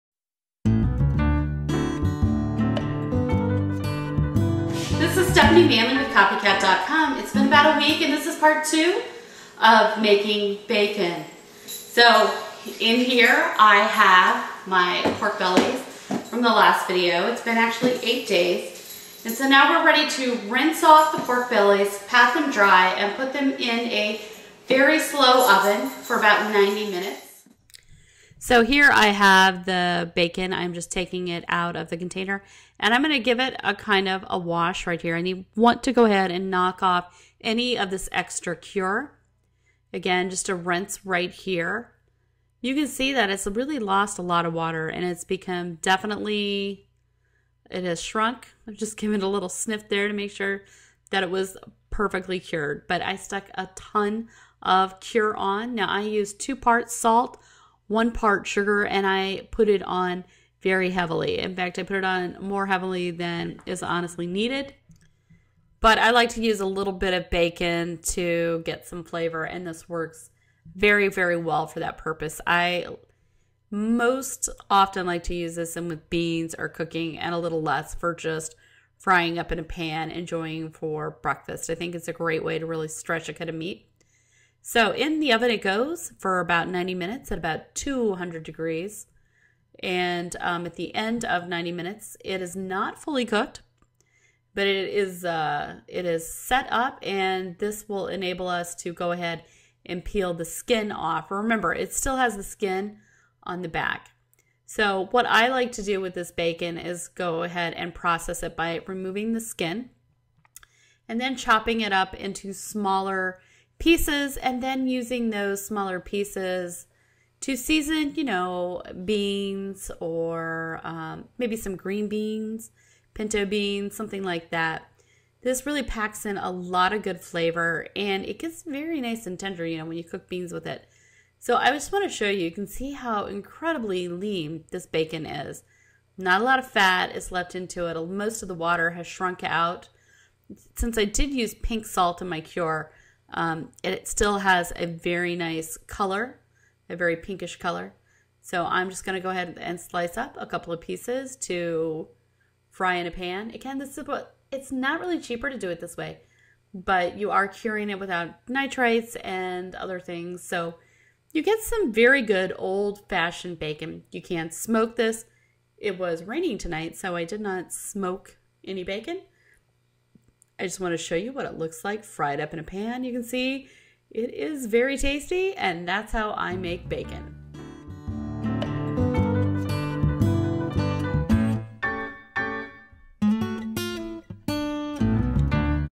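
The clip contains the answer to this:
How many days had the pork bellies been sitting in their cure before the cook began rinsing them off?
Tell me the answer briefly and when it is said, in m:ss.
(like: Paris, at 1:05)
8 days, at 0:18.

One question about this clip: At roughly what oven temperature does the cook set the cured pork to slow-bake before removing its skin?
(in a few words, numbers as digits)
200 degrees.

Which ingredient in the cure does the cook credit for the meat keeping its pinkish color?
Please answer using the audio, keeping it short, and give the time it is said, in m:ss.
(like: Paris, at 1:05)
Pink salt, at 2:21.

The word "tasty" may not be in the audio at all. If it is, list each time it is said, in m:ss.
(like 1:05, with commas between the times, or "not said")
2:54.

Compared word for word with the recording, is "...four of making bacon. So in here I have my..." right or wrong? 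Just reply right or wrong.
wrong.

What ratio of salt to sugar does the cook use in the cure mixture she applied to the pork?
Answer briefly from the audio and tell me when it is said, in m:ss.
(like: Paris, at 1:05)
2 parts salt, 1 part sugar, at 0:56.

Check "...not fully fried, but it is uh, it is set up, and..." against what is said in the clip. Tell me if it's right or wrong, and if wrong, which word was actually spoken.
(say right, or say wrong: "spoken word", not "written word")
wrong: "cooked", not "fried".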